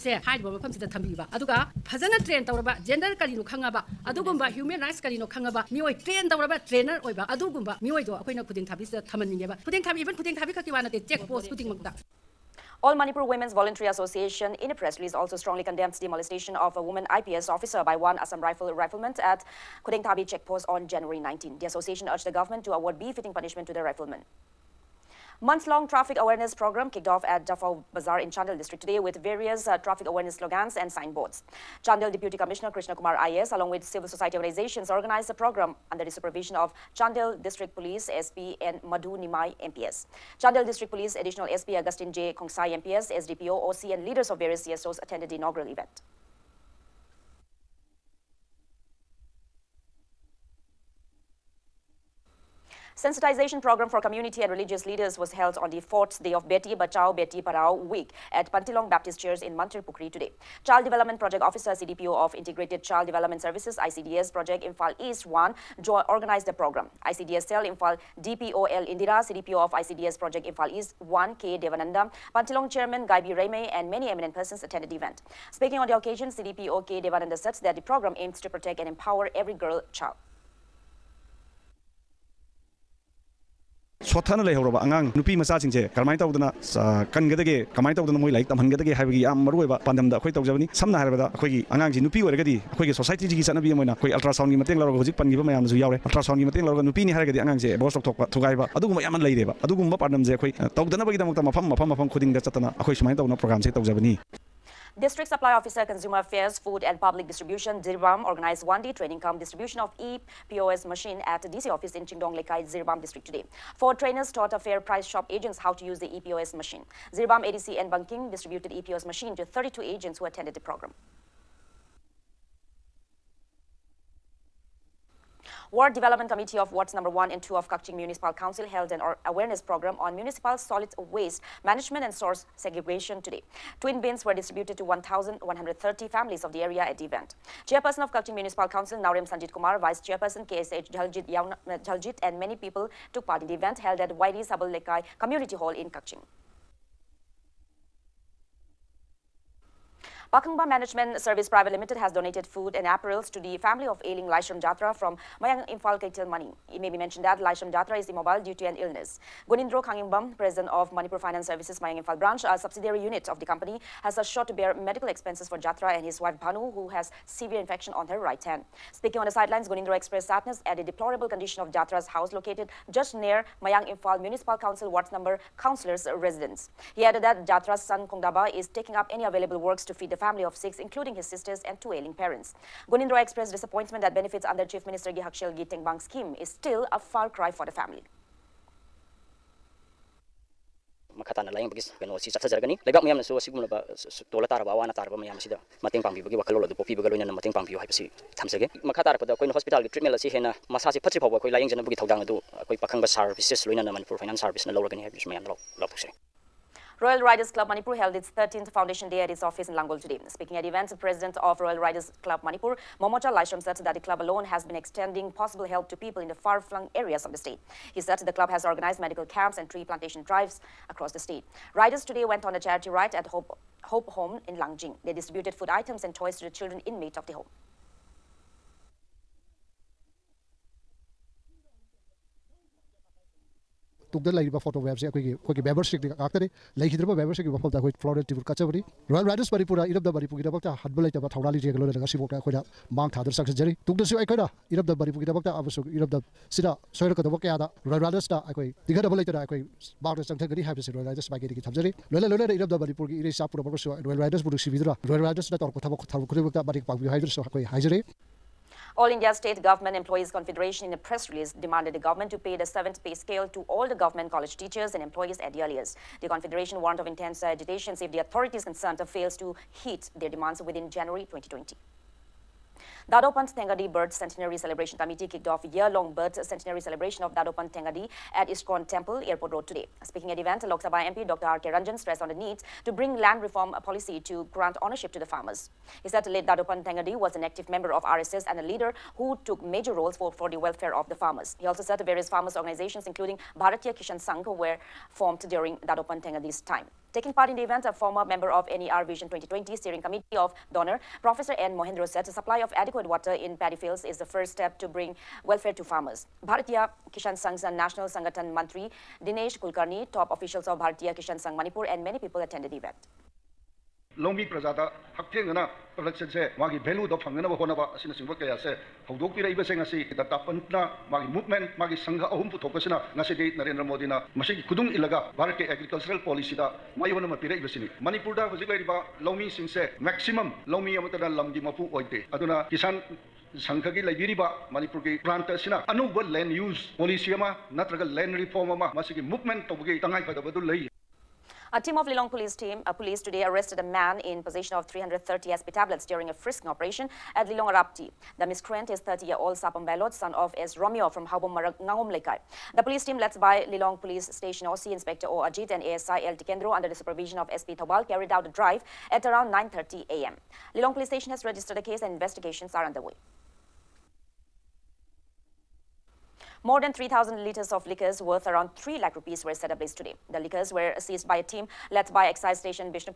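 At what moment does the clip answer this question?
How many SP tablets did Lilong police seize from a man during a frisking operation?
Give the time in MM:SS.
05:44.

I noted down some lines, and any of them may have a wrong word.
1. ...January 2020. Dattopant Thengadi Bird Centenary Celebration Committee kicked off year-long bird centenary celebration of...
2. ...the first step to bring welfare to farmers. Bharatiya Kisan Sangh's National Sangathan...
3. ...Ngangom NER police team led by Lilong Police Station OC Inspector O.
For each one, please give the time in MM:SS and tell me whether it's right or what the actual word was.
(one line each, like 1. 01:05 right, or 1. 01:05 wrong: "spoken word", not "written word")
1. 04:30 right
2. 05:04 right
3. 05:51 wrong: "The", not "NER".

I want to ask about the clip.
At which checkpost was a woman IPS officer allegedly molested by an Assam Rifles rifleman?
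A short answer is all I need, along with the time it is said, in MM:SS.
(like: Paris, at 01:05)
Kudengthabi, at 00:19.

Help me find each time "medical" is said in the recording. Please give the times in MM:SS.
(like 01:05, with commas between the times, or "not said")
02:44, 03:39.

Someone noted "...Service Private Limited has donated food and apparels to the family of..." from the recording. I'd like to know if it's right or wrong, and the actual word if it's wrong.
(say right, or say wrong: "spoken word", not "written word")
right.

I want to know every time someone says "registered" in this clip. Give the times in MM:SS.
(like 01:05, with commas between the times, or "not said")
06:01.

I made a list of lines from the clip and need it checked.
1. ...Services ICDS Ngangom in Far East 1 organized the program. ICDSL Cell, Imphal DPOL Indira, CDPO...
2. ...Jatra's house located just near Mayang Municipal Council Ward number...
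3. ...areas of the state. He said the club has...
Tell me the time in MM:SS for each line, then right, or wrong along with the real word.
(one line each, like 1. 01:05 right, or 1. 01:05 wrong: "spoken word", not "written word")
1. 01:03 wrong: "Project", not "Ngangom"
2. 02:51 right
3. 03:36 right.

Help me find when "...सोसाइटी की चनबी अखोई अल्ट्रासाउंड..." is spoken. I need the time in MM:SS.
01:32.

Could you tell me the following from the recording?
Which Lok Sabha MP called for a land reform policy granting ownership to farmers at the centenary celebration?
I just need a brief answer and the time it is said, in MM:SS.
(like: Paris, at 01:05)
Dr. R. K. Ranjan, at 04:41.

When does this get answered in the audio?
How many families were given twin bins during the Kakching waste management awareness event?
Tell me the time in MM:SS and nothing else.
02:14.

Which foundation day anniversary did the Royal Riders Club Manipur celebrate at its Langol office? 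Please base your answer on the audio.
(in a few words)
13th.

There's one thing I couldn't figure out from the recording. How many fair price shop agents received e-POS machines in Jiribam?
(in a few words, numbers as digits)
32.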